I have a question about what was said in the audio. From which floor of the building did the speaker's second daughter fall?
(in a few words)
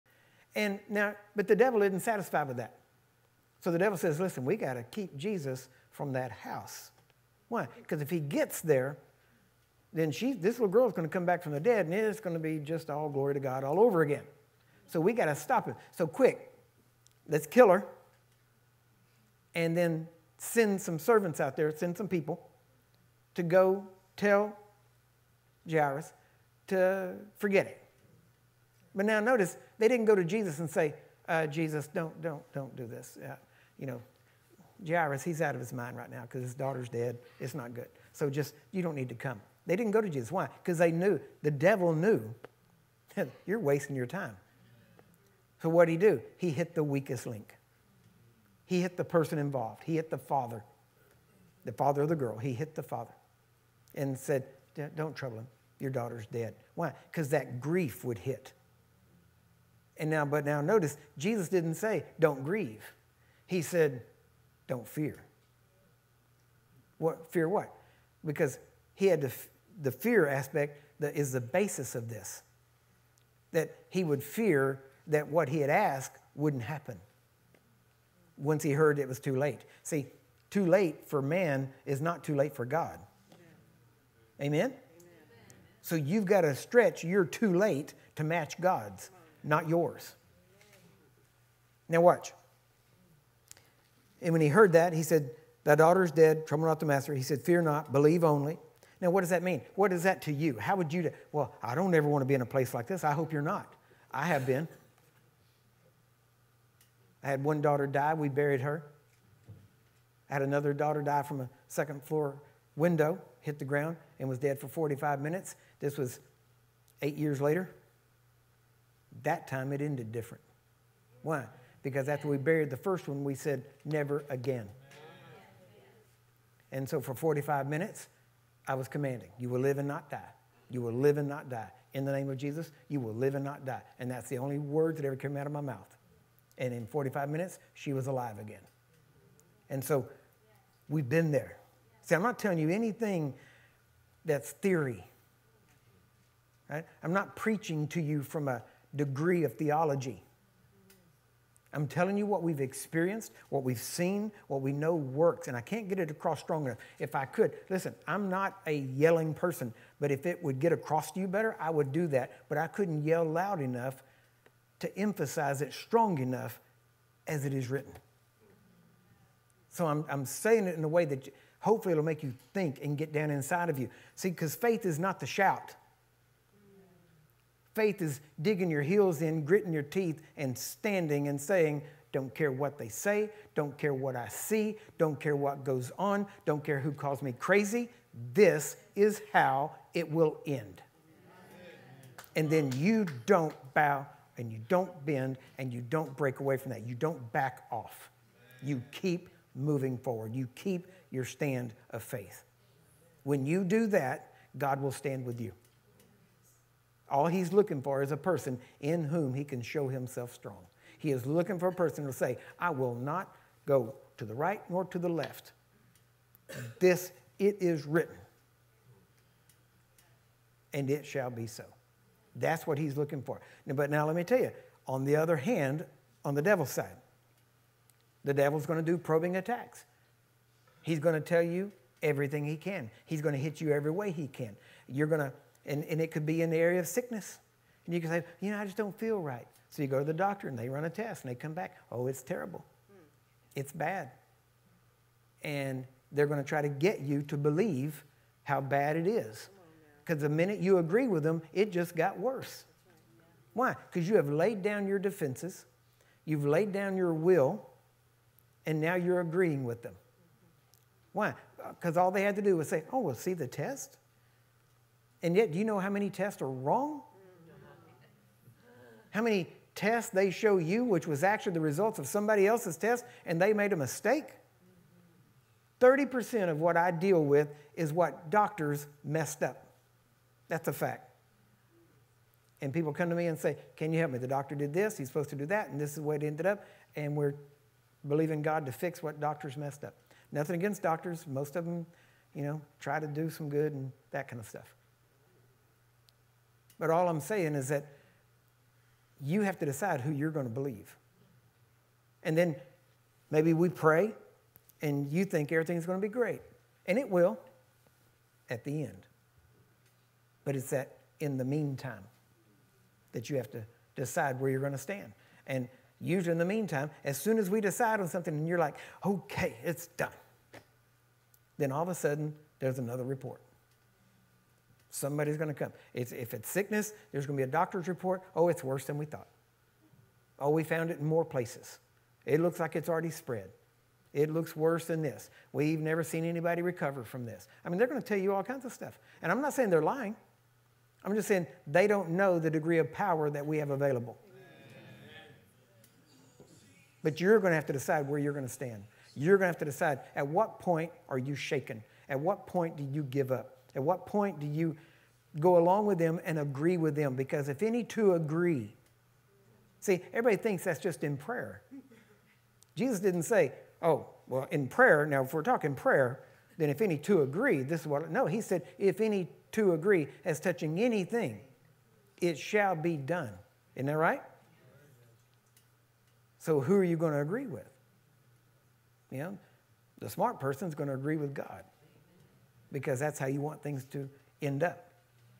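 second floor.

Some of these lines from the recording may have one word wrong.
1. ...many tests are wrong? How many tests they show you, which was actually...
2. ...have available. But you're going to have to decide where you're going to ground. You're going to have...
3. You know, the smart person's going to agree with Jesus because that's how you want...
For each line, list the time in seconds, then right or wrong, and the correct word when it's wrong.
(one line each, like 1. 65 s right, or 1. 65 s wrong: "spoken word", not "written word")
1. 265 s right
2. 343 s wrong: "stand", not "ground"
3. 379 s wrong: "God", not "Jesus".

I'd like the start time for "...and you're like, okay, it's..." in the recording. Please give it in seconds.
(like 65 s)
318 s.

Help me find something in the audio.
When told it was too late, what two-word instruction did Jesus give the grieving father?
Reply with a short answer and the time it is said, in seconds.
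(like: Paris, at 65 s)
Fear not, at 97 s.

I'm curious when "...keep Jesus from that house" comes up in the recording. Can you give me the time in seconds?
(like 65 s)
4 s.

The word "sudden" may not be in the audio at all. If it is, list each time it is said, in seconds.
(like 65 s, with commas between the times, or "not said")
321 s.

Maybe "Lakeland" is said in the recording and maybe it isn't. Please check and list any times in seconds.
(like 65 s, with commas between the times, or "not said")
not said.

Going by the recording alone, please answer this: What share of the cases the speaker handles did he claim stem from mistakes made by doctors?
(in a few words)
30%.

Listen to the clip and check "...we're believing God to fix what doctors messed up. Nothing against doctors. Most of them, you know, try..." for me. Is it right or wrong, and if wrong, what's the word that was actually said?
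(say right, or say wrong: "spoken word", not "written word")
right.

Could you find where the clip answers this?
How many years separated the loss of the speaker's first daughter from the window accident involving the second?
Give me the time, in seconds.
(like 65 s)
117 s.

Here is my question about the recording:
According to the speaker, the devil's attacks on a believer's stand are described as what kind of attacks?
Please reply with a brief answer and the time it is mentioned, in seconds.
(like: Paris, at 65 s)
probing attacks, at 228 s.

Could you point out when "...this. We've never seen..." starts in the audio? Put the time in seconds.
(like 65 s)
335 s.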